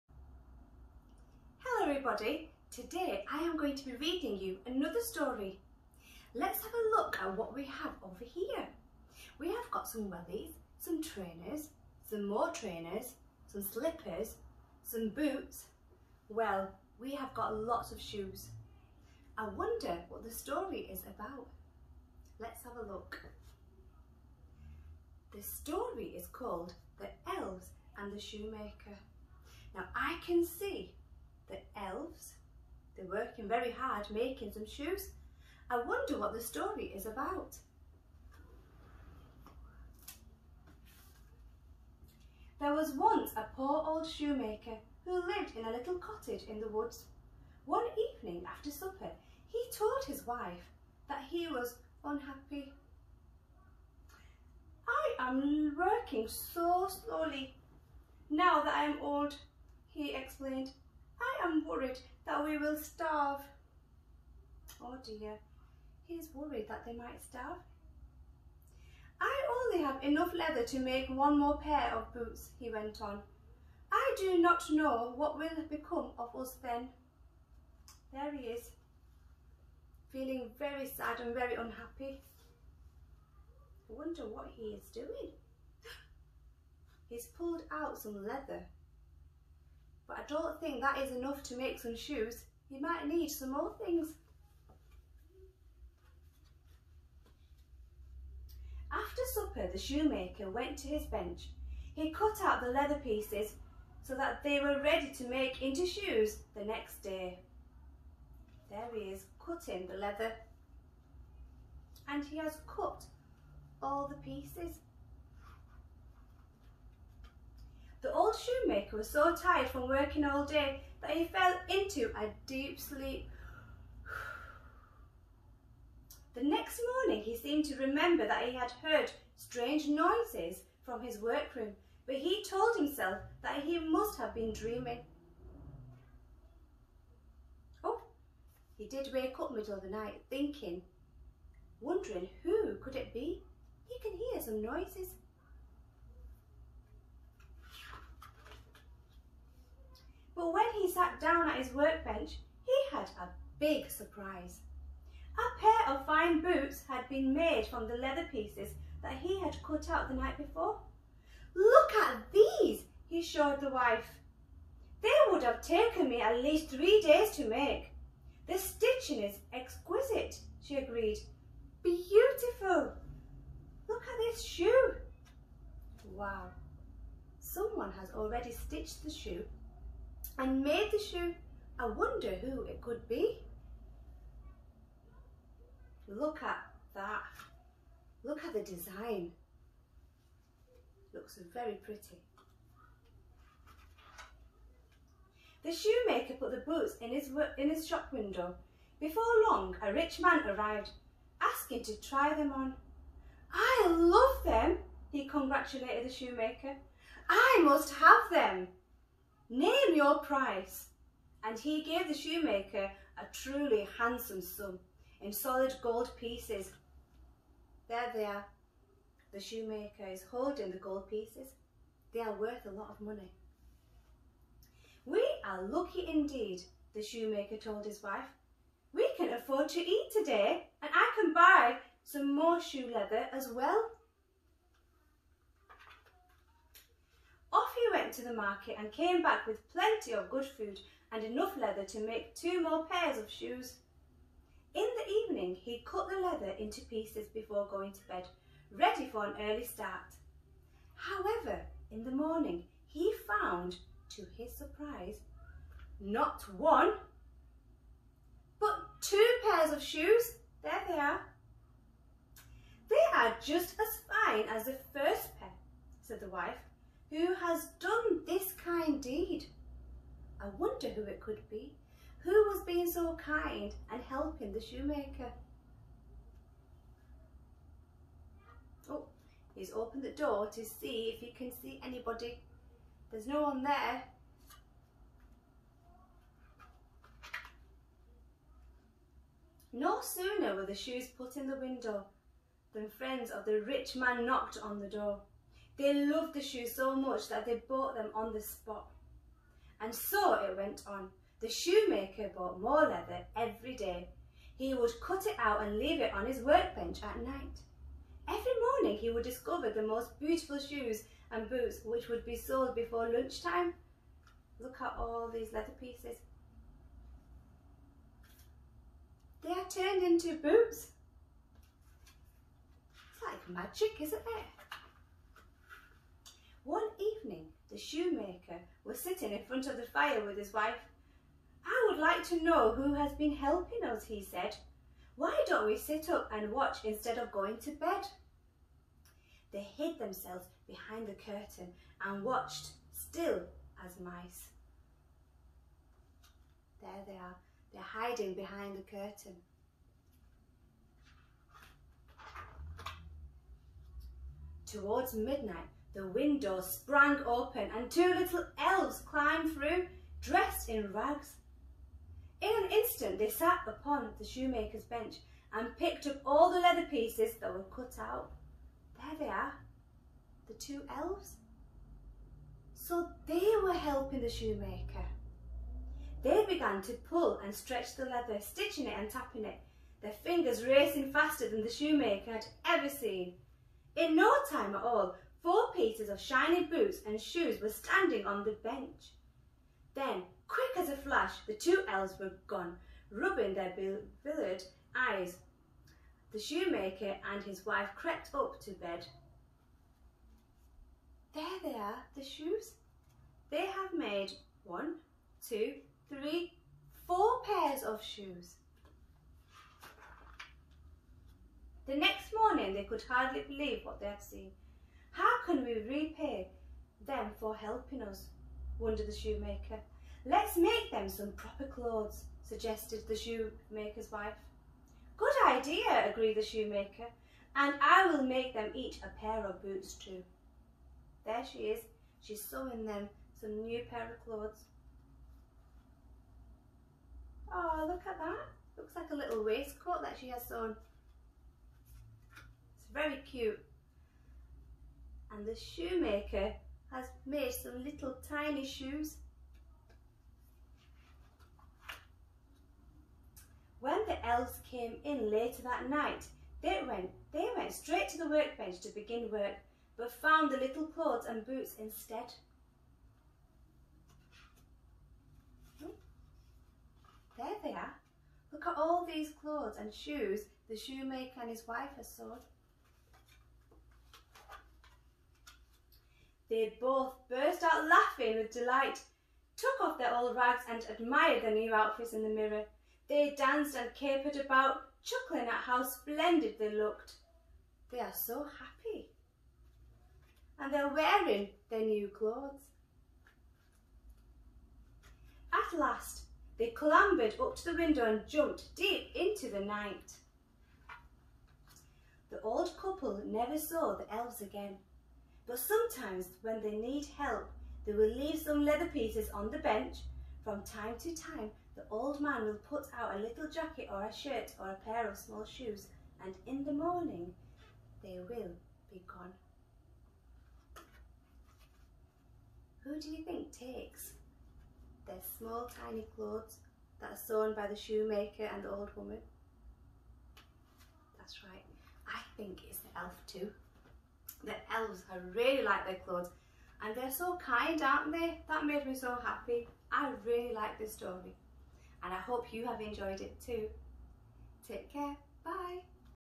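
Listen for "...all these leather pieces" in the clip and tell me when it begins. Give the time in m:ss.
5:14.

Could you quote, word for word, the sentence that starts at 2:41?
Look at these, he showed the wife.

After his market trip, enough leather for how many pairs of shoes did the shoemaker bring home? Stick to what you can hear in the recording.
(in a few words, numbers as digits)
2.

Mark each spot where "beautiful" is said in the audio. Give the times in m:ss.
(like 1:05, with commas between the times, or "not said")
2:51, 5:10.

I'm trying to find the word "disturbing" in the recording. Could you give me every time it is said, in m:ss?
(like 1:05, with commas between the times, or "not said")
not said.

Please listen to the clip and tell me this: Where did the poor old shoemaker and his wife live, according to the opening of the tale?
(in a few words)
A little cottage in the woods.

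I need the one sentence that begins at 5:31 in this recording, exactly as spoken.
I would like to know who has been helping us, he said.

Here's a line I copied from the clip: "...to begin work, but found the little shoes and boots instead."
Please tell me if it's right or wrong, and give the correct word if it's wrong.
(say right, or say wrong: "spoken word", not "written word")
wrong: "clothes", not "shoes".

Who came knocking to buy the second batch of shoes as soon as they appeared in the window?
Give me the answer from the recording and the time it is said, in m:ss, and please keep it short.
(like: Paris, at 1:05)
Friends of the rich man, at 4:52.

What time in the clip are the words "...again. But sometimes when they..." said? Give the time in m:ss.
8:24.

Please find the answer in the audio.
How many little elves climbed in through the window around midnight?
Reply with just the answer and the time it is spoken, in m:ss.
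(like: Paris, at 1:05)
2, at 5:57.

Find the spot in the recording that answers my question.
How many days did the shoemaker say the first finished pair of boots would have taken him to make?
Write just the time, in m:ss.
2:46.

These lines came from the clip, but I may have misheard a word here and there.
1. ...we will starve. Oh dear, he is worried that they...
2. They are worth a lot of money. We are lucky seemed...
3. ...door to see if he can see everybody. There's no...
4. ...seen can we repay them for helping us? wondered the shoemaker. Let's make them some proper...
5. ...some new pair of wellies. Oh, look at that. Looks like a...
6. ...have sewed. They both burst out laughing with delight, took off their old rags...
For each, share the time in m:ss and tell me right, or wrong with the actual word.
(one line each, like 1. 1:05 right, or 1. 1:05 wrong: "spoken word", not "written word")
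1. 1:02 right
2. 3:42 wrong: "indeed", not "seemed"
3. 4:40 wrong: "anybody", not "everybody"
4. 6:54 right
5. 7:13 wrong: "clothes", not "wellies"
6. 7:51 right.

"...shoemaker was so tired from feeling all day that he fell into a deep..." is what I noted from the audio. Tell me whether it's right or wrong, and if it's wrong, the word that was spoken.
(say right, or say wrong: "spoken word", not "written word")
wrong: "working", not "feeling".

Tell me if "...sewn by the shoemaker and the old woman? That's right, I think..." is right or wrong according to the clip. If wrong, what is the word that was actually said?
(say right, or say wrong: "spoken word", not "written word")
right.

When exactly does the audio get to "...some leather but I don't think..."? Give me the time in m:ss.
1:27.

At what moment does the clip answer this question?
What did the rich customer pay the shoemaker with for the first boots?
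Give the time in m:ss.
3:35.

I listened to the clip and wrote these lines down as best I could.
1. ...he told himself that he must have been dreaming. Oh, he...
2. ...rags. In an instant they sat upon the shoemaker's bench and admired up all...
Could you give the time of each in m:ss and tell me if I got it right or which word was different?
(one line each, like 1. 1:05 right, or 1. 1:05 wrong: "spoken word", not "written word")
1. 2:12 right
2. 6:00 wrong: "picked", not "admired".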